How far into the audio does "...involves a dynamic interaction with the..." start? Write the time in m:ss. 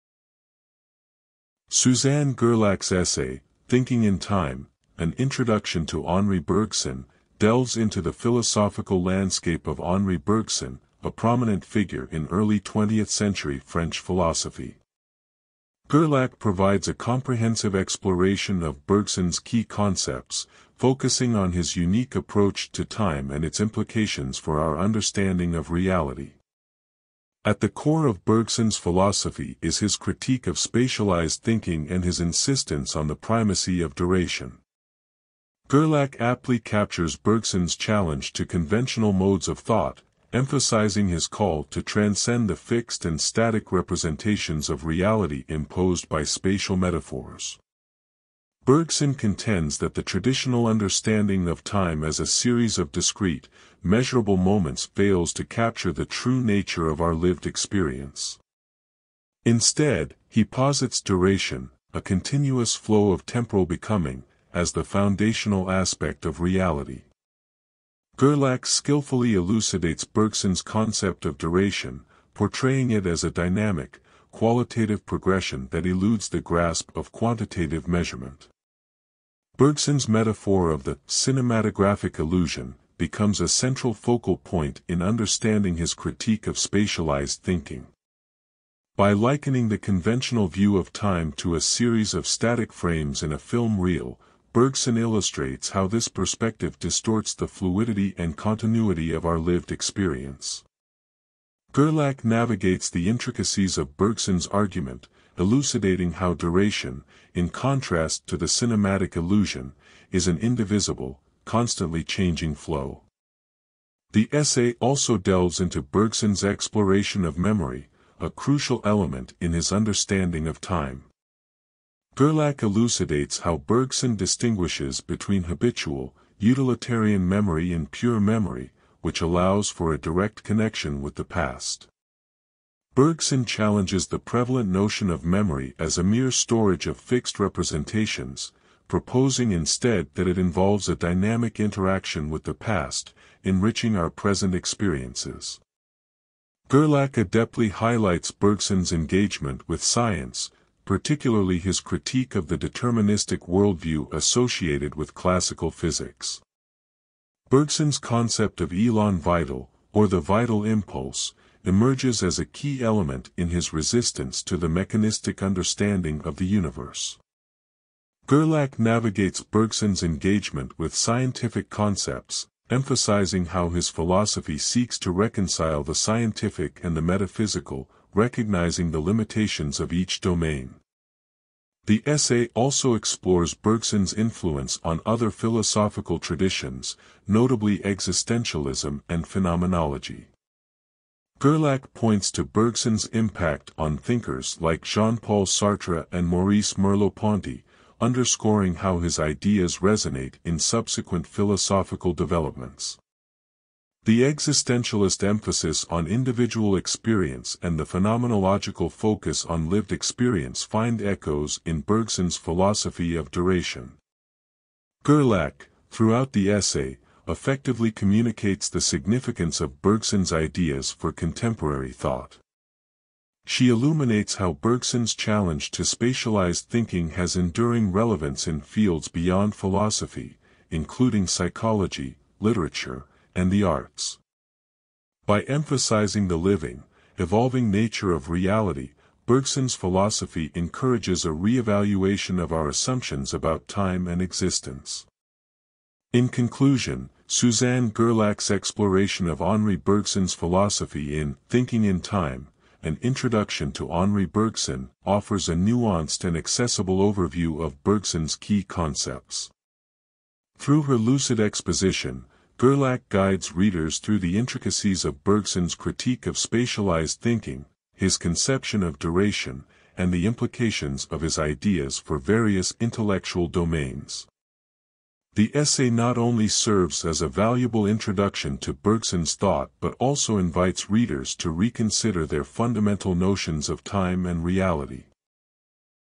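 2:20.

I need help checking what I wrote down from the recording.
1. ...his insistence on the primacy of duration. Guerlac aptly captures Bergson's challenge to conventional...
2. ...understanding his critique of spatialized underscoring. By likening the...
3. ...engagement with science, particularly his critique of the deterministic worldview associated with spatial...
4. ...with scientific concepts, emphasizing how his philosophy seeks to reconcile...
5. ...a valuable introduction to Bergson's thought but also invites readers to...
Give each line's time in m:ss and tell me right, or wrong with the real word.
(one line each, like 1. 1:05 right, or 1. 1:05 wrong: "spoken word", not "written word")
1. 0:32 right
2. 1:25 wrong: "thinking", not "underscoring"
3. 2:28 wrong: "classical", not "spatial"
4. 2:50 right
5. 4:37 right.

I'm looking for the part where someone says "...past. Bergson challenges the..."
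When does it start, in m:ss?
2:11.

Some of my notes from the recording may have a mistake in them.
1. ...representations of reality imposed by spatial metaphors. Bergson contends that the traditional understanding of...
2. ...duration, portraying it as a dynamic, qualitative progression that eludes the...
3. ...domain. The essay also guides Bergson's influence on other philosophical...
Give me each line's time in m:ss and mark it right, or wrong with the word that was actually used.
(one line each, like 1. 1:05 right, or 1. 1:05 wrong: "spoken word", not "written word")
1. 0:43 right
2. 1:11 right
3. 3:00 wrong: "explores", not "guides".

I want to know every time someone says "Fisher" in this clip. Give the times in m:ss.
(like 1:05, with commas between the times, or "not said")
not said.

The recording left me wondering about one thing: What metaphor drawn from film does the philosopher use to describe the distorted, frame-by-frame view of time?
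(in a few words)
cinematographic illusion.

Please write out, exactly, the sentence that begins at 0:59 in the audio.
Instead, he posits duration, a continuous flow of temporal becoming, as the foundational aspect of reality.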